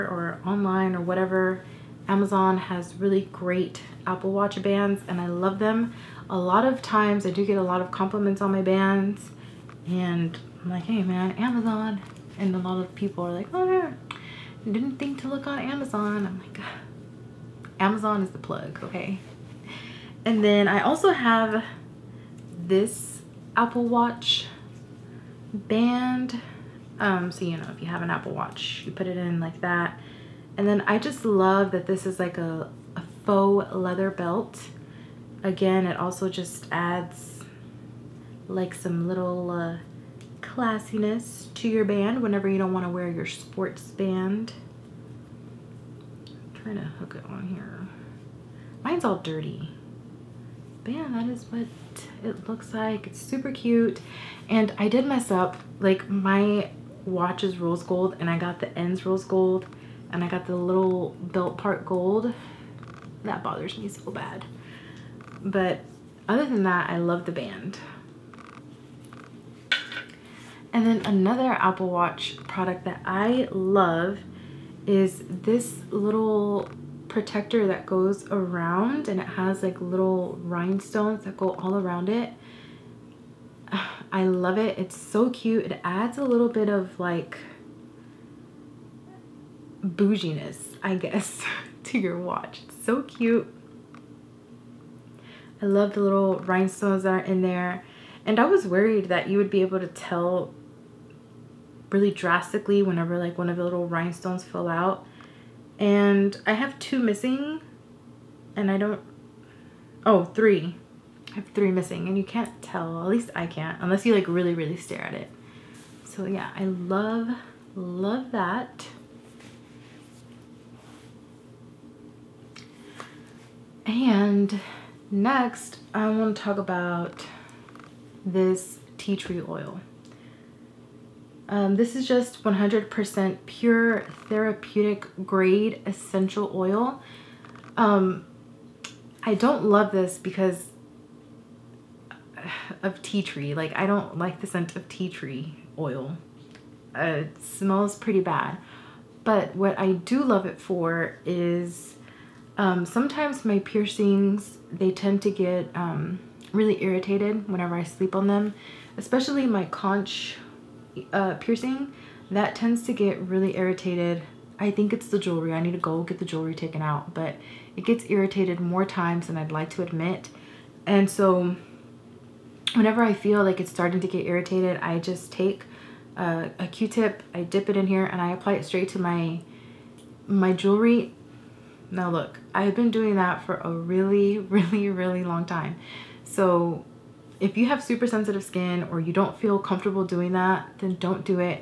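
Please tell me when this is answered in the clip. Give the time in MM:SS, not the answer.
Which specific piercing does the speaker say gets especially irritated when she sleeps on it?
02:39.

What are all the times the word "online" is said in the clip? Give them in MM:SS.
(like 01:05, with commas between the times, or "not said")
00:00.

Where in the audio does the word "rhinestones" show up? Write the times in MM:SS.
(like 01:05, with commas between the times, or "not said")
01:20, 01:36, 01:43.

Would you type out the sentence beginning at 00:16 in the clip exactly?
I'm like, Amazon is the plug, okay?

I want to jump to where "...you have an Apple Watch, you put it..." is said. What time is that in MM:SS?
00:27.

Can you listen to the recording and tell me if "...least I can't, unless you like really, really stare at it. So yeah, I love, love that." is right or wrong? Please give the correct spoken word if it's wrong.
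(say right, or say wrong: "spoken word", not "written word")
right.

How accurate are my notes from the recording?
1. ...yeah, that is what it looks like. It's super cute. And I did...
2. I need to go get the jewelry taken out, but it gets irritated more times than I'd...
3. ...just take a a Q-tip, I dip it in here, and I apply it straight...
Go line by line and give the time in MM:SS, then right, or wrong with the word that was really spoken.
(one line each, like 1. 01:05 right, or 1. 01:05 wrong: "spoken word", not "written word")
1. 00:50 right
2. 02:45 right
3. 02:54 right.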